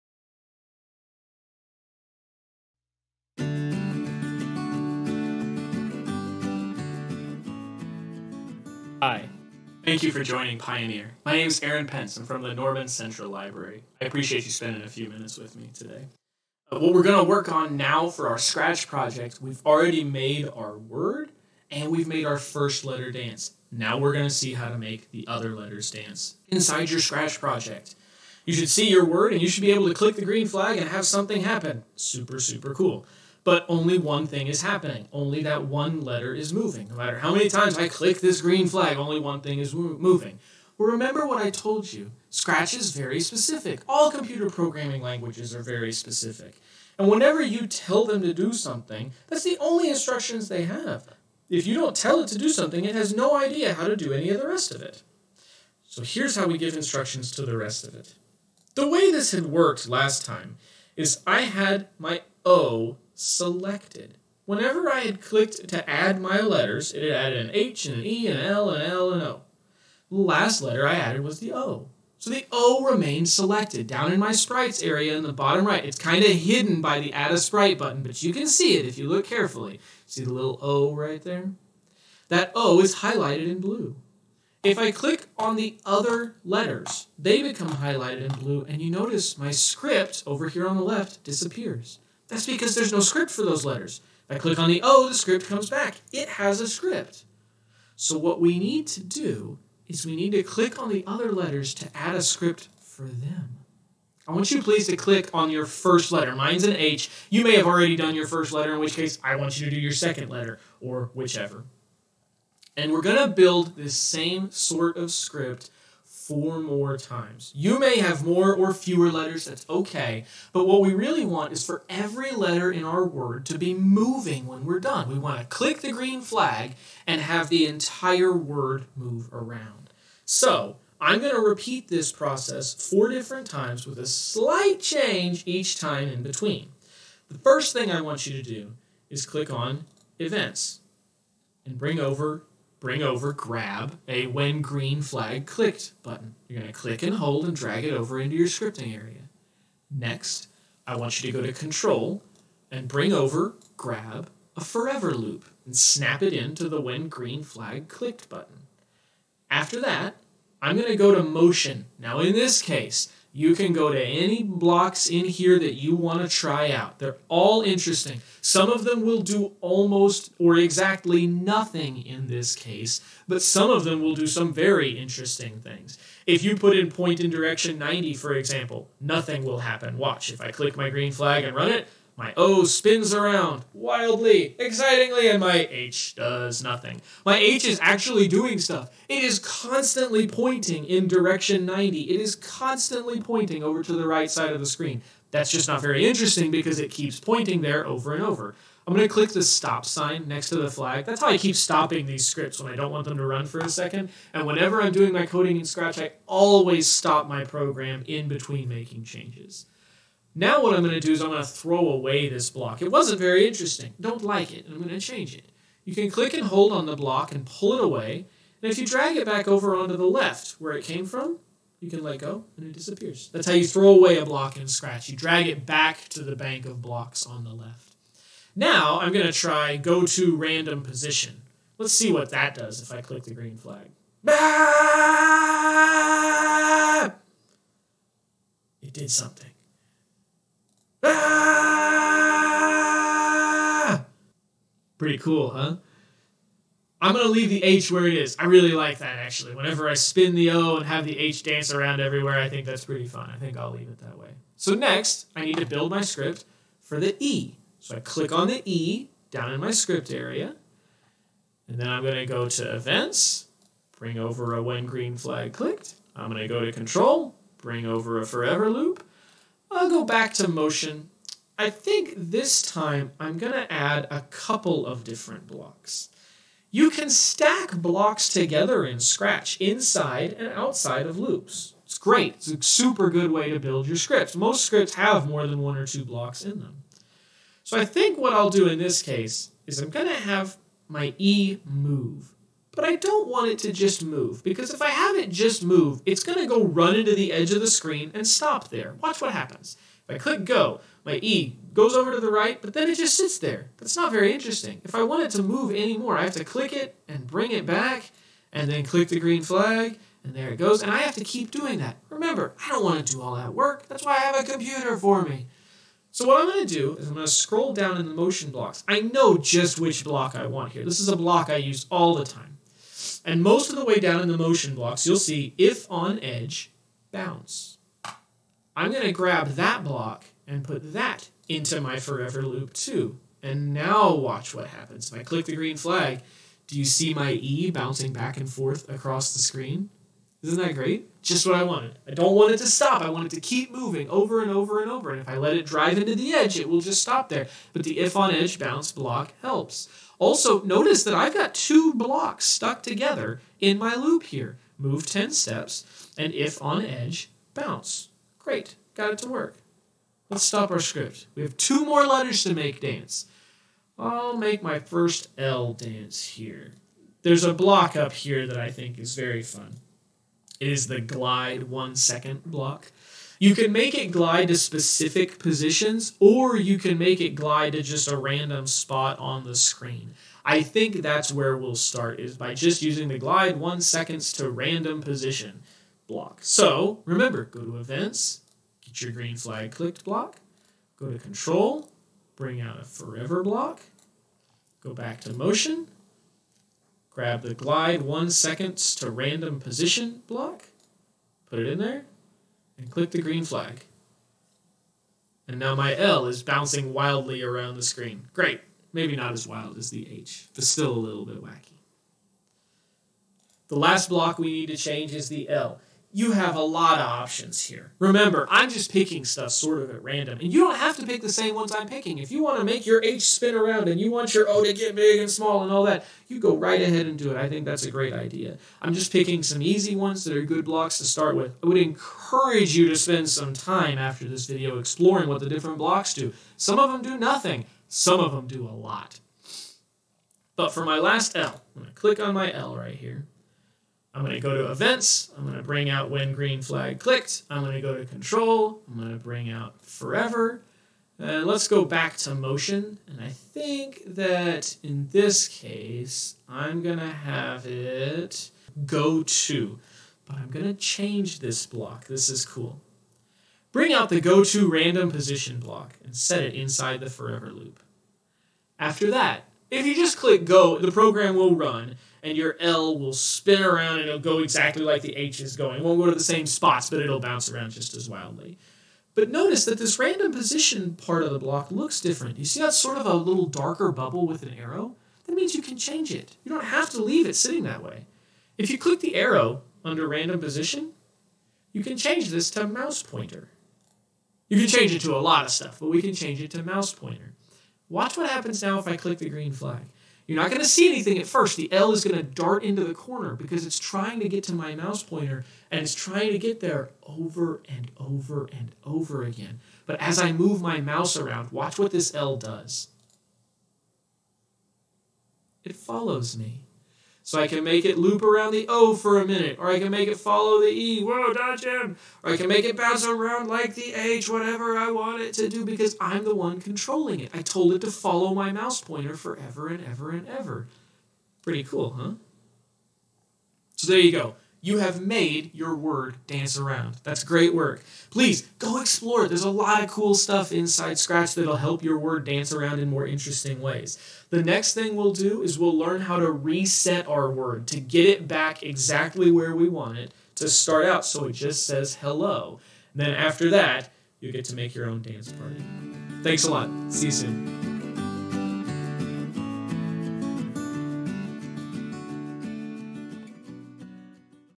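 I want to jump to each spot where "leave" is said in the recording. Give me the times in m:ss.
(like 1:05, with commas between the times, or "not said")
4:07, 4:13, 8:07.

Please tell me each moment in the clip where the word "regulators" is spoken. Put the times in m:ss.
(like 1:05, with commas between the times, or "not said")
not said.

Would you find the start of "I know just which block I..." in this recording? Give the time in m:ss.
5:18.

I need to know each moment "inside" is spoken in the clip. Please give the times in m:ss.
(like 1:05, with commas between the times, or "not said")
0:26, 4:39, 7:46, 9:00.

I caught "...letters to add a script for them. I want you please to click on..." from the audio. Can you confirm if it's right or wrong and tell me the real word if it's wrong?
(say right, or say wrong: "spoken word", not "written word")
right.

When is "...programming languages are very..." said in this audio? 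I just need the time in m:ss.
0:44.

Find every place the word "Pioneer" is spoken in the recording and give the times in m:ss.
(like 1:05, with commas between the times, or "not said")
0:10.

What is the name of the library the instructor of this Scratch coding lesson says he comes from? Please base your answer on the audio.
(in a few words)
Norman Central Library.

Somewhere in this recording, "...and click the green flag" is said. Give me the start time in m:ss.
6:42.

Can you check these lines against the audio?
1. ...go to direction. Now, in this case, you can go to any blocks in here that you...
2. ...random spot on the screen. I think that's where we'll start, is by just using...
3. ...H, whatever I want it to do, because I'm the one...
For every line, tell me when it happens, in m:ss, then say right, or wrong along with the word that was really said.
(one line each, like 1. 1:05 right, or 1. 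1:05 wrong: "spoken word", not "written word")
1. 2:40 wrong: "motion", not "direction"
2. 6:18 right
3. 8:43 right.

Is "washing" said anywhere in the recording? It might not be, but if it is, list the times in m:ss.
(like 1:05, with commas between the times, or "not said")
not said.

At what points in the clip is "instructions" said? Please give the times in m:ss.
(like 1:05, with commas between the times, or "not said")
0:49, 0:56.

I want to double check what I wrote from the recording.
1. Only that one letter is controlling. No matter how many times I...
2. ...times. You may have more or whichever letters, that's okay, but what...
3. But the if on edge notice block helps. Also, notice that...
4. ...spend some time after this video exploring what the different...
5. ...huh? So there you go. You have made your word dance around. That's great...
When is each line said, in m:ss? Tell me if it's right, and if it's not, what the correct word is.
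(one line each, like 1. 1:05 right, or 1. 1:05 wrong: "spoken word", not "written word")
1. 0:35 wrong: "moving", not "controlling"
2. 1:56 wrong: "fewer", not "whichever"
3. 5:47 wrong: "bounce", not "notice"
4. 7:12 right
5. 8:51 right.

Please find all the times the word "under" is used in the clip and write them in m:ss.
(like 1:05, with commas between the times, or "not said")
8:09.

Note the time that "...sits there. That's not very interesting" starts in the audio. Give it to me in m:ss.
5:03.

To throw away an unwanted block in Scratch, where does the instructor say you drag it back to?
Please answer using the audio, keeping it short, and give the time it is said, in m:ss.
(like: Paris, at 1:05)
Bank of blocks, at 3:46.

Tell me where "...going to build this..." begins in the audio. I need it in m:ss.
1:53.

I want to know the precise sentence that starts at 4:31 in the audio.
I think this time I'm going to add a couple of different blocks.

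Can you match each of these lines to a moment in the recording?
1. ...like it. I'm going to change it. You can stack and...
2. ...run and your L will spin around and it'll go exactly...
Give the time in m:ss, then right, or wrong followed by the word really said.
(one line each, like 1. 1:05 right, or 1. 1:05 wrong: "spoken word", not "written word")
1. 3:34 wrong: "click", not "stack"
2. 7:51 right.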